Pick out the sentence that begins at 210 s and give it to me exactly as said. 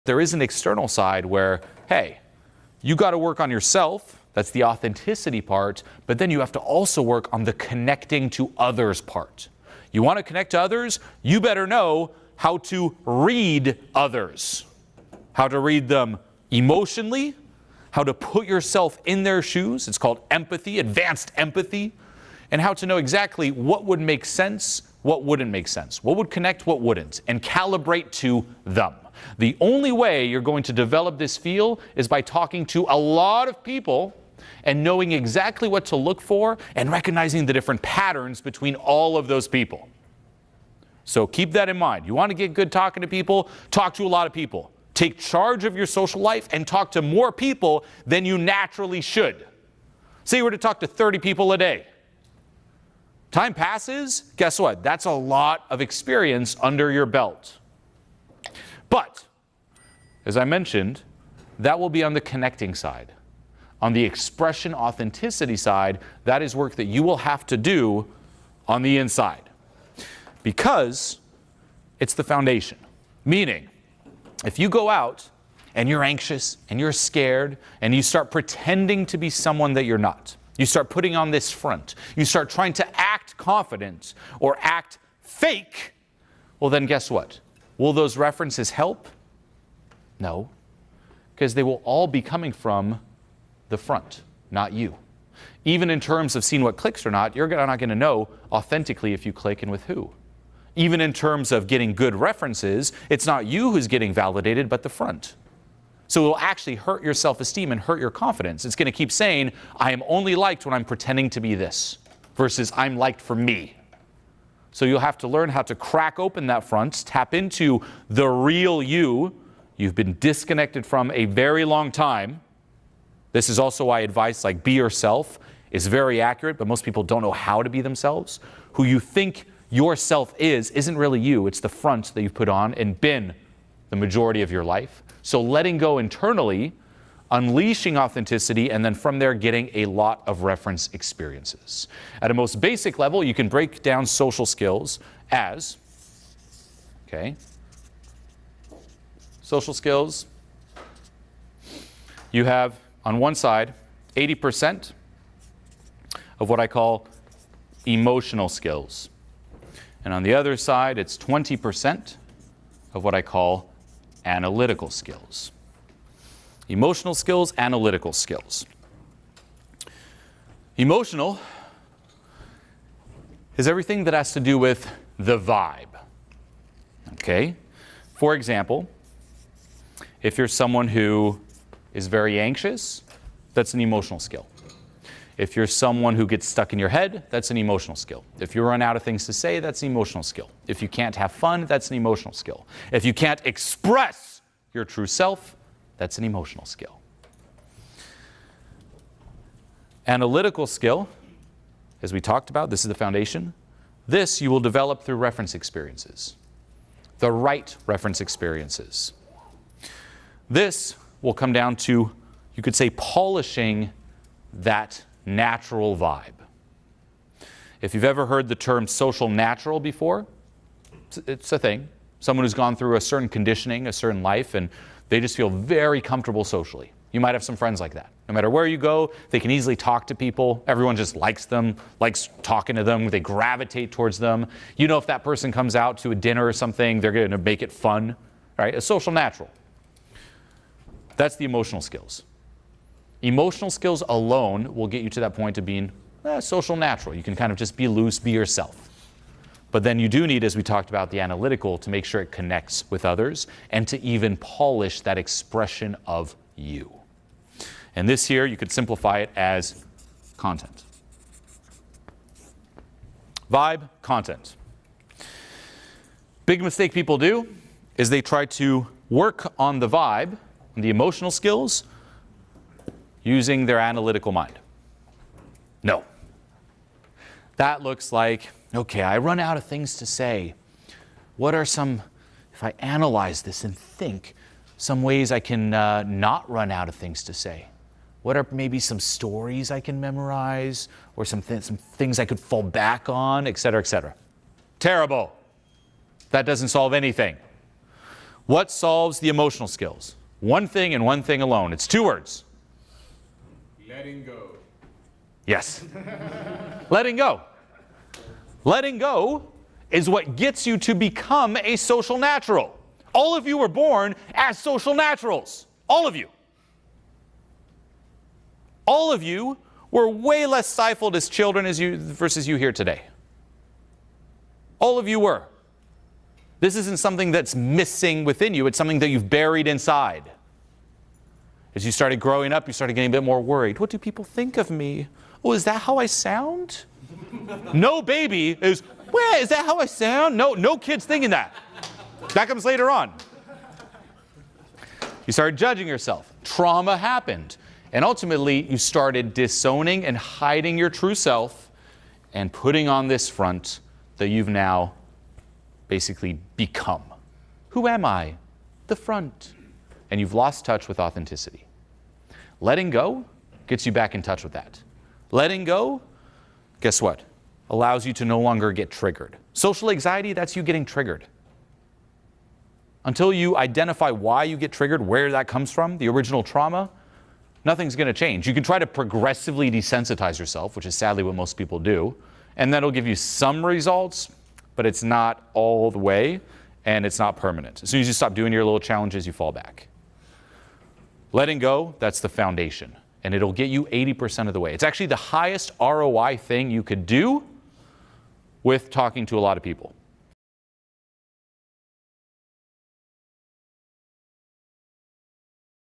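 This will come down to, you could say, polishing that natural vibe.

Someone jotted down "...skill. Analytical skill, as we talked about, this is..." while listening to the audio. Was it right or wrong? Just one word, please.
right.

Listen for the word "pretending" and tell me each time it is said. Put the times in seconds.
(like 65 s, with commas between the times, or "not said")
78 s, 110 s.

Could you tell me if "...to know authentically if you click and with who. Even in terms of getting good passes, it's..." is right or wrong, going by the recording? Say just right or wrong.
wrong.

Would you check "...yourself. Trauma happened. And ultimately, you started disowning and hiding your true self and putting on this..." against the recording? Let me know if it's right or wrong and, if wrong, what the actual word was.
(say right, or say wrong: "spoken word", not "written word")
right.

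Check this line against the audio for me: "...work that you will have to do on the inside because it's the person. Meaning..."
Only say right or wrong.
wrong.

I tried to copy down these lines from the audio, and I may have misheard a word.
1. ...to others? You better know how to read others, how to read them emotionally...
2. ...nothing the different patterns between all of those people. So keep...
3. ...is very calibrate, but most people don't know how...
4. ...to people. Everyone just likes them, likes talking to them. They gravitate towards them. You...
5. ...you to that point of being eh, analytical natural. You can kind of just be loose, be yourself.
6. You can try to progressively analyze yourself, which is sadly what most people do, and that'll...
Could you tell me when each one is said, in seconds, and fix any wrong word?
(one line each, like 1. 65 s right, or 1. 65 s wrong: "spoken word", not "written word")
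1. 10 s right
2. 36 s wrong: "recognizing", not "nothing"
3. 125 s wrong: "accurate", not "calibrate"
4. 230 s right
5. 245 s wrong: "social", not "analytical"
6. 378 s wrong: "desensitize", not "analyze".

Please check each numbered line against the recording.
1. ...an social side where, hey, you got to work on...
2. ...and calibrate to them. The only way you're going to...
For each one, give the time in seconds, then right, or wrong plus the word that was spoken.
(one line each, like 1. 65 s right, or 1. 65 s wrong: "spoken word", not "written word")
1. 0 s wrong: "external", not "social"
2. 27 s right.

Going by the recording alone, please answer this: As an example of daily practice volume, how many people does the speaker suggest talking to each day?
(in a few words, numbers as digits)
30.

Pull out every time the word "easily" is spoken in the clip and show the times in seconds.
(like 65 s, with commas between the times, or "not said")
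229 s.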